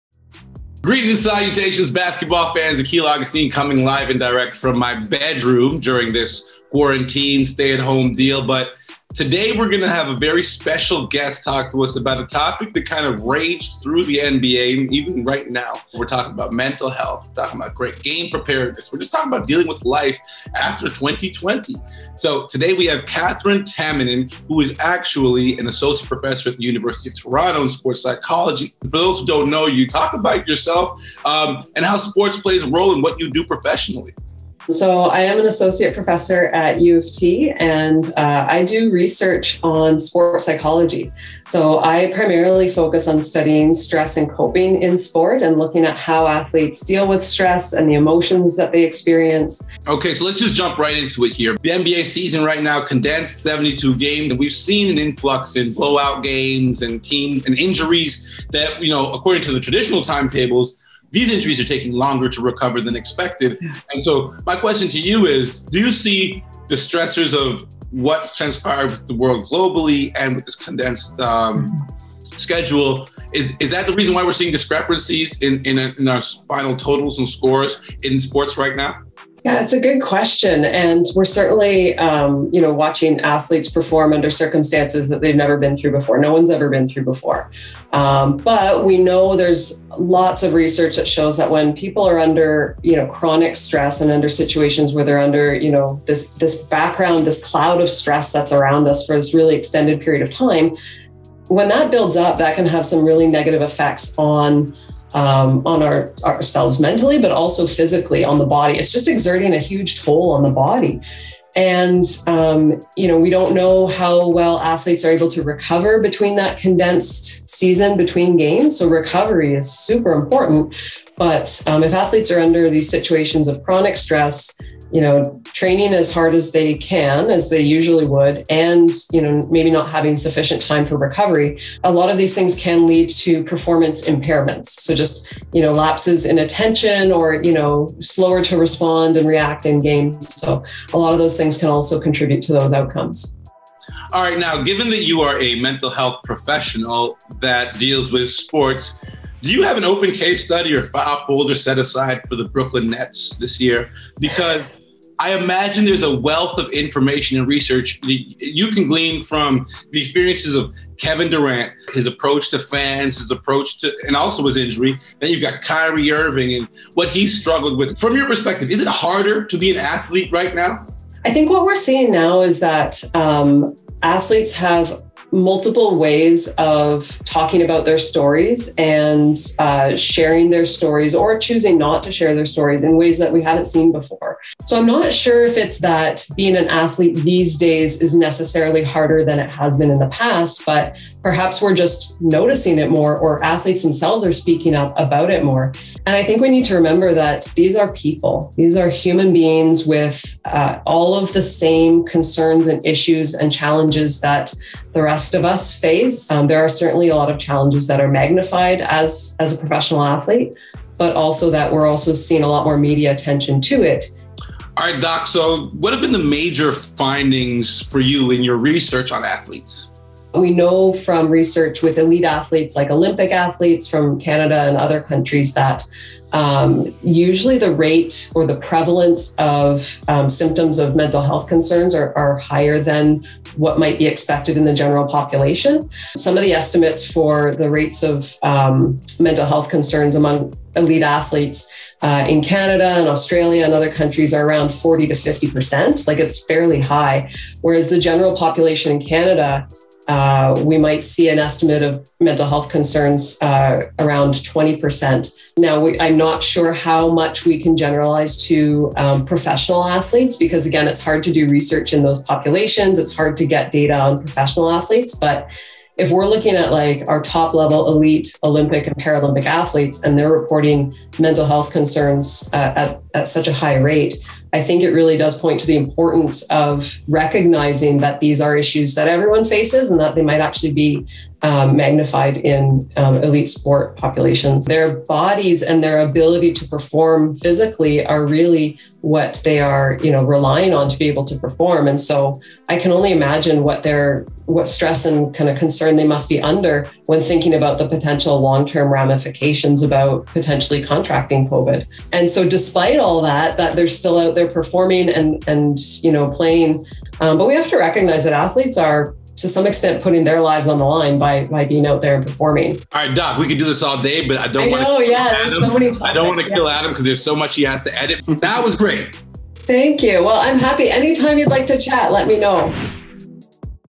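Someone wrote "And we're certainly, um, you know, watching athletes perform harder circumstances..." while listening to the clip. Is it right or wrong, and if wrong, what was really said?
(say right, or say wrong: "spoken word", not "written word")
wrong: "under", not "harder".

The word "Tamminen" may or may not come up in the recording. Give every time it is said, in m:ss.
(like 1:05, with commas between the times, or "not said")
0:23.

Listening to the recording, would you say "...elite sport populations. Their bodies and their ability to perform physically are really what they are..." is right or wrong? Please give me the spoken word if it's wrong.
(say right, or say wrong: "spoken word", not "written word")
right.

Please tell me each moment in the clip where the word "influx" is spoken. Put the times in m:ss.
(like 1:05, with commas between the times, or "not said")
0:54.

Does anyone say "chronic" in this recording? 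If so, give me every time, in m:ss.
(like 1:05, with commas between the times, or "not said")
1:33, 2:03.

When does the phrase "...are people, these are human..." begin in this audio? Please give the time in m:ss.
3:17.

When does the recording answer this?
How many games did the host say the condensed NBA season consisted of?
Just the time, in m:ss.
0:53.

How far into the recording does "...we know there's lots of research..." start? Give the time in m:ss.
1:28.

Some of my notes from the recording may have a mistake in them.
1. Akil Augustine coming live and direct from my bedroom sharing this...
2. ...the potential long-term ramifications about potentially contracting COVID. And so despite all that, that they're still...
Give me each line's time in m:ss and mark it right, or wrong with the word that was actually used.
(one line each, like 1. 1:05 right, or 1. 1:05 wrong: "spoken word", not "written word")
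1. 0:02 wrong: "during", not "sharing"
2. 4:57 right.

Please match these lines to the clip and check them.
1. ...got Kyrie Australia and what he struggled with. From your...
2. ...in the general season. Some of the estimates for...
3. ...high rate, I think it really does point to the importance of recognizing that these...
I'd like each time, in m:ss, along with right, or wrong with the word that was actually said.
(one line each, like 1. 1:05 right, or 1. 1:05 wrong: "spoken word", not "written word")
1. 2:45 wrong: "Irving", not "Australia"
2. 3:54 wrong: "population", not "season"
3. 4:33 right.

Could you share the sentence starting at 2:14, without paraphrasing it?
So just, you know, lapses in attention or, you know, slower to respond and react in games.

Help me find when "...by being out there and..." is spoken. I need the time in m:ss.
5:11.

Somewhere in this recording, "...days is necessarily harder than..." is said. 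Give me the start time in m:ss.
3:07.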